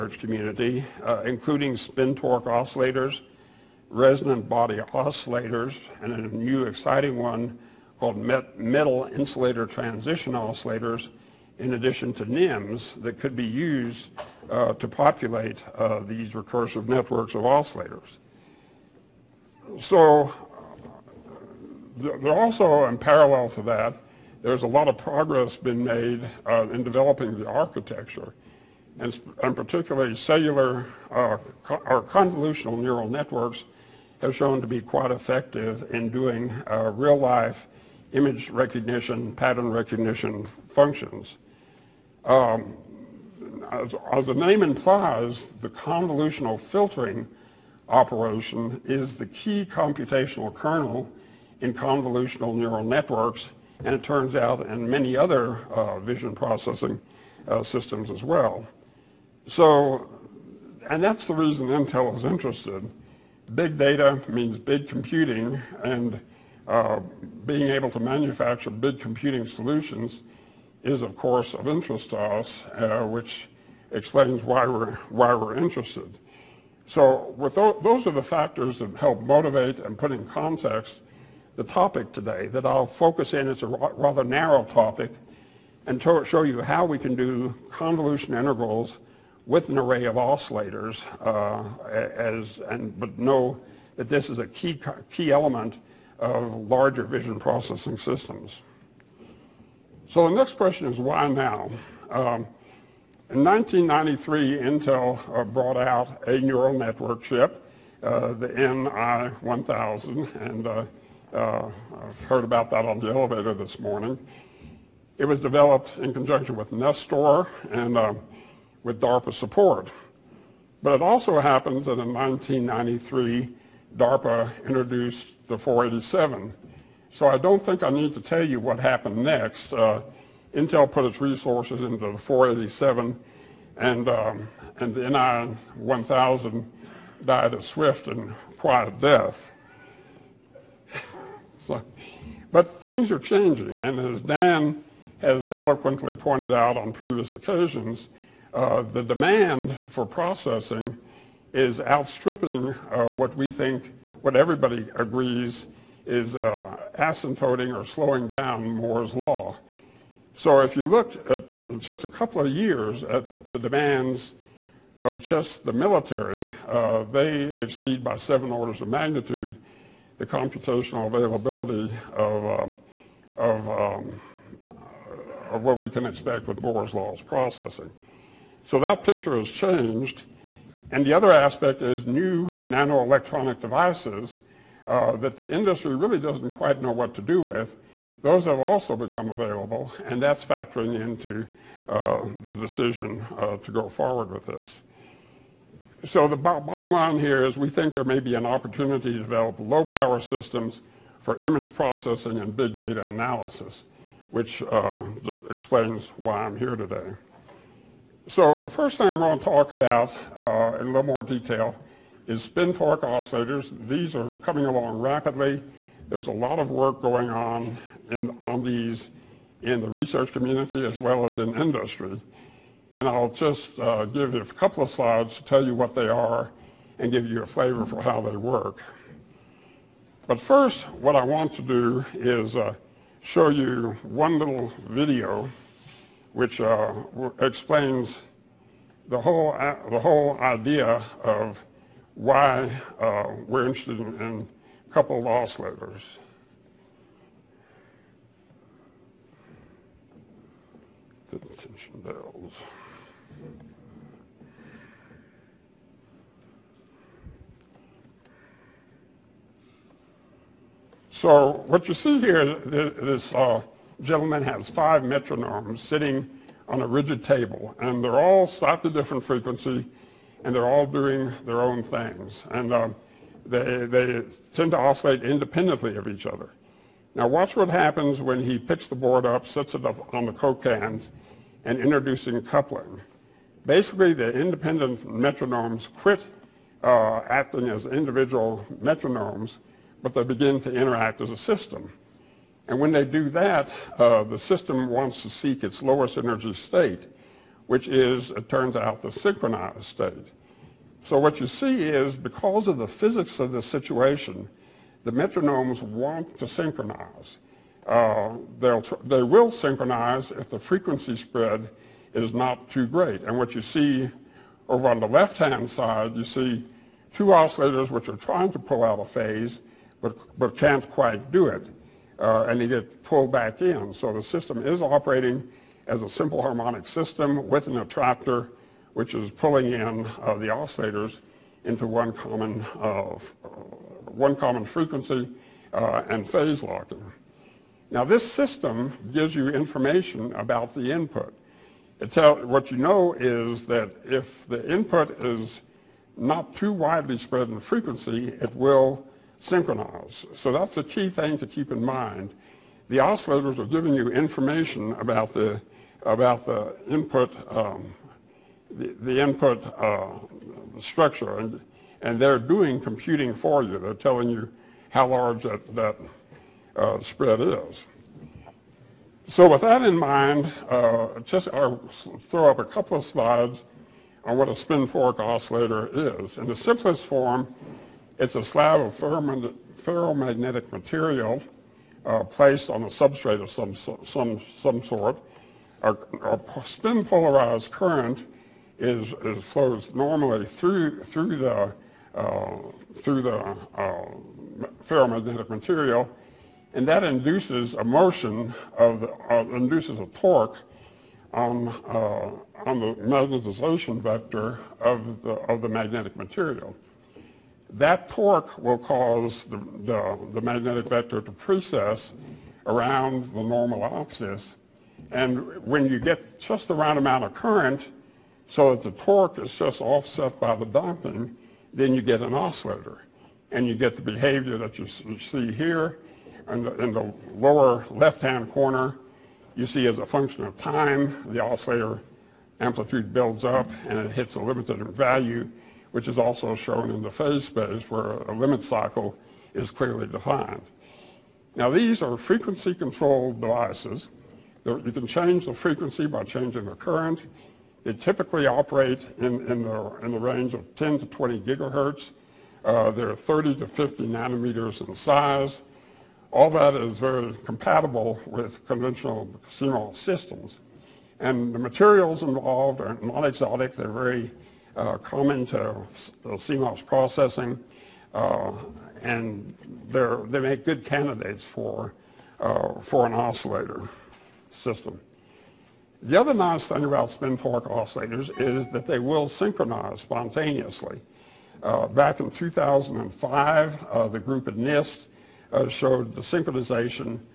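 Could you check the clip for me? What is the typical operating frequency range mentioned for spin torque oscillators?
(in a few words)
10 to 20 gigahertz.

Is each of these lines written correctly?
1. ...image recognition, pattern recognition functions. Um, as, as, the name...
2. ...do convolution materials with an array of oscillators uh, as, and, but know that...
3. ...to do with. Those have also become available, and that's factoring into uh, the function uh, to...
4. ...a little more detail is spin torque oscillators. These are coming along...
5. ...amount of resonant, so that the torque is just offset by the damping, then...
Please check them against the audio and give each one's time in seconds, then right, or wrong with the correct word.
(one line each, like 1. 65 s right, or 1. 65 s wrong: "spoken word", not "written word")
1. 38 s right
2. 87 s wrong: "integrals", not "materials"
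3. 187 s wrong: "decision", not "function"
4. 210 s right
5. 416 s wrong: "current", not "resonant".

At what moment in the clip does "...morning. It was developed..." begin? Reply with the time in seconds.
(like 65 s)
113 s.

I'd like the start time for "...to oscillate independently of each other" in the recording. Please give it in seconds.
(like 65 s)
274 s.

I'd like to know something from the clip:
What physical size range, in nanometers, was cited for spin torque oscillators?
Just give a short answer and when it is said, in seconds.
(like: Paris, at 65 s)
30 to 50 nanometers, at 453 s.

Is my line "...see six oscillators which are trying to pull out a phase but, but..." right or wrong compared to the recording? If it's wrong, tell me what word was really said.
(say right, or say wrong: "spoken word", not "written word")
wrong: "two", not "six".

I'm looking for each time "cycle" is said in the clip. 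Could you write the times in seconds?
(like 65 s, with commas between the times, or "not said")
438 s.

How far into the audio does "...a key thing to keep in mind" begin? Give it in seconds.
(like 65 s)
350 s.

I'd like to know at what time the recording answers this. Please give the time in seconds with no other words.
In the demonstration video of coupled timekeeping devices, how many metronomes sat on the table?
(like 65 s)
264 s.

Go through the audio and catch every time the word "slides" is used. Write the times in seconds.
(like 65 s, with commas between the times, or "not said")
224 s, 373 s.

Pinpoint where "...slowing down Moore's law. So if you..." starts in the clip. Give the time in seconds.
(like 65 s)
157 s.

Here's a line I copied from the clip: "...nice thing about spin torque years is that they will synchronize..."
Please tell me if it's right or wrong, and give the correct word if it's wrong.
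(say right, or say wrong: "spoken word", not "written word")
wrong: "oscillators", not "years".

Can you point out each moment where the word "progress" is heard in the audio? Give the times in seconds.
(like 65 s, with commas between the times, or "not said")
24 s.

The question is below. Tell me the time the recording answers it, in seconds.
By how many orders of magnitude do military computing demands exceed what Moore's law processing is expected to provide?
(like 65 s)
168 s.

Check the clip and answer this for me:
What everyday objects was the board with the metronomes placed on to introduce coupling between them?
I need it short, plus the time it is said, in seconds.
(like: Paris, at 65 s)
coke cans, at 280 s.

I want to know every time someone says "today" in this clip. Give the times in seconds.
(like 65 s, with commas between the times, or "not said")
82 s, 206 s.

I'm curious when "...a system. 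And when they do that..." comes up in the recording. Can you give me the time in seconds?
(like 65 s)
291 s.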